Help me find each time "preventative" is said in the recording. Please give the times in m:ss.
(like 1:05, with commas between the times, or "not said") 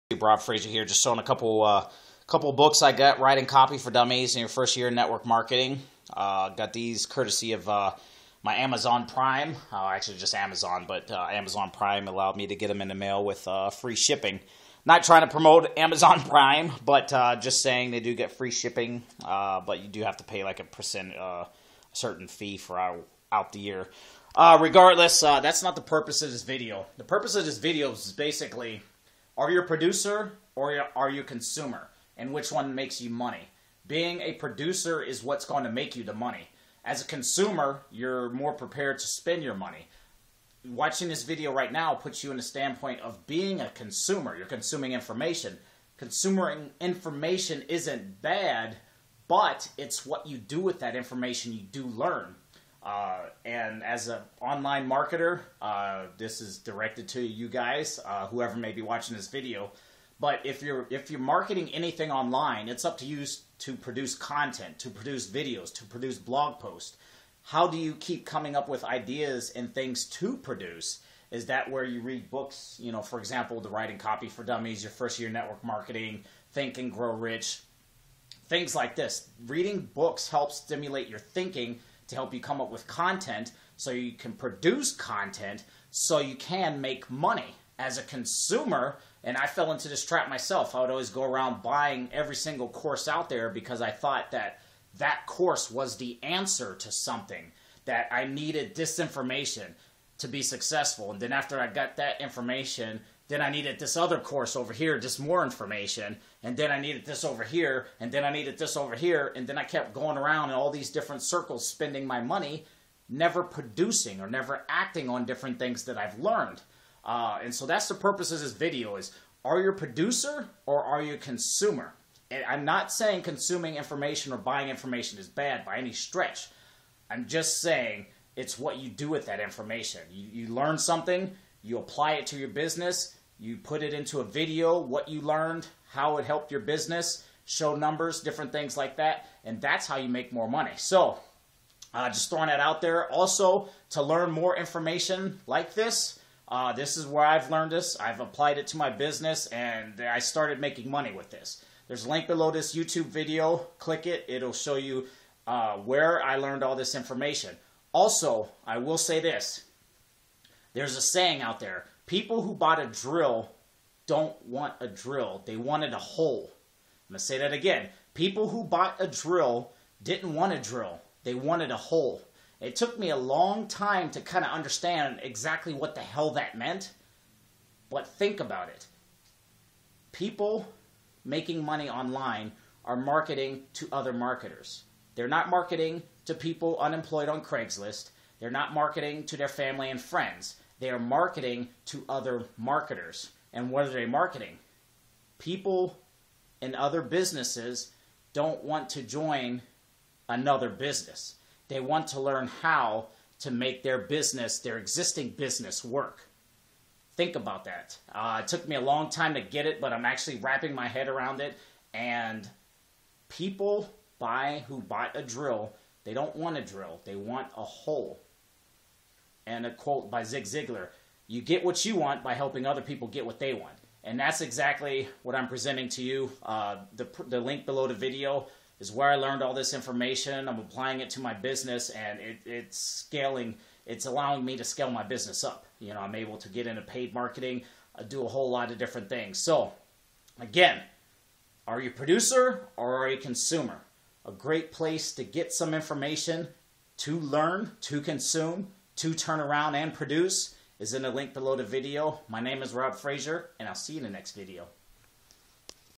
not said.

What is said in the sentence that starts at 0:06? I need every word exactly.
Uh, got these courtesy of uh, my Amazon Prime.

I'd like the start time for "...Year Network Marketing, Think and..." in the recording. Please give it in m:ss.
1:15.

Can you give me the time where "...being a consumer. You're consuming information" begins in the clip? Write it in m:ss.
0:43.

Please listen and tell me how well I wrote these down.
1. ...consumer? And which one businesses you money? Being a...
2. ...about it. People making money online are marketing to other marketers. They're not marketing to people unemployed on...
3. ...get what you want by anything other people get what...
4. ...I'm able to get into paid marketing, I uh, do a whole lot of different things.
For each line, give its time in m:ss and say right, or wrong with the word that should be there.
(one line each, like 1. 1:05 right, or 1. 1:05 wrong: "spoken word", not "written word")
1. 0:31 wrong: "makes", not "businesses"
2. 2:58 right
3. 3:41 wrong: "helping", not "anything"
4. 3:56 right.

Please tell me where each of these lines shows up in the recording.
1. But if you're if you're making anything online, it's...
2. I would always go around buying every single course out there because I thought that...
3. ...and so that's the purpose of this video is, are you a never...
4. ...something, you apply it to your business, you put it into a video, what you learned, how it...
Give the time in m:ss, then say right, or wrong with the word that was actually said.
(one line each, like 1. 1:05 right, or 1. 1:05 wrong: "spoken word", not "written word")
1. 1:00 wrong: "marketing", not "making"
2. 1:30 right
3. 1:57 wrong: "producer", not "never"
4. 2:10 right.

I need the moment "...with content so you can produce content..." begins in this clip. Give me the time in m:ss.
1:22.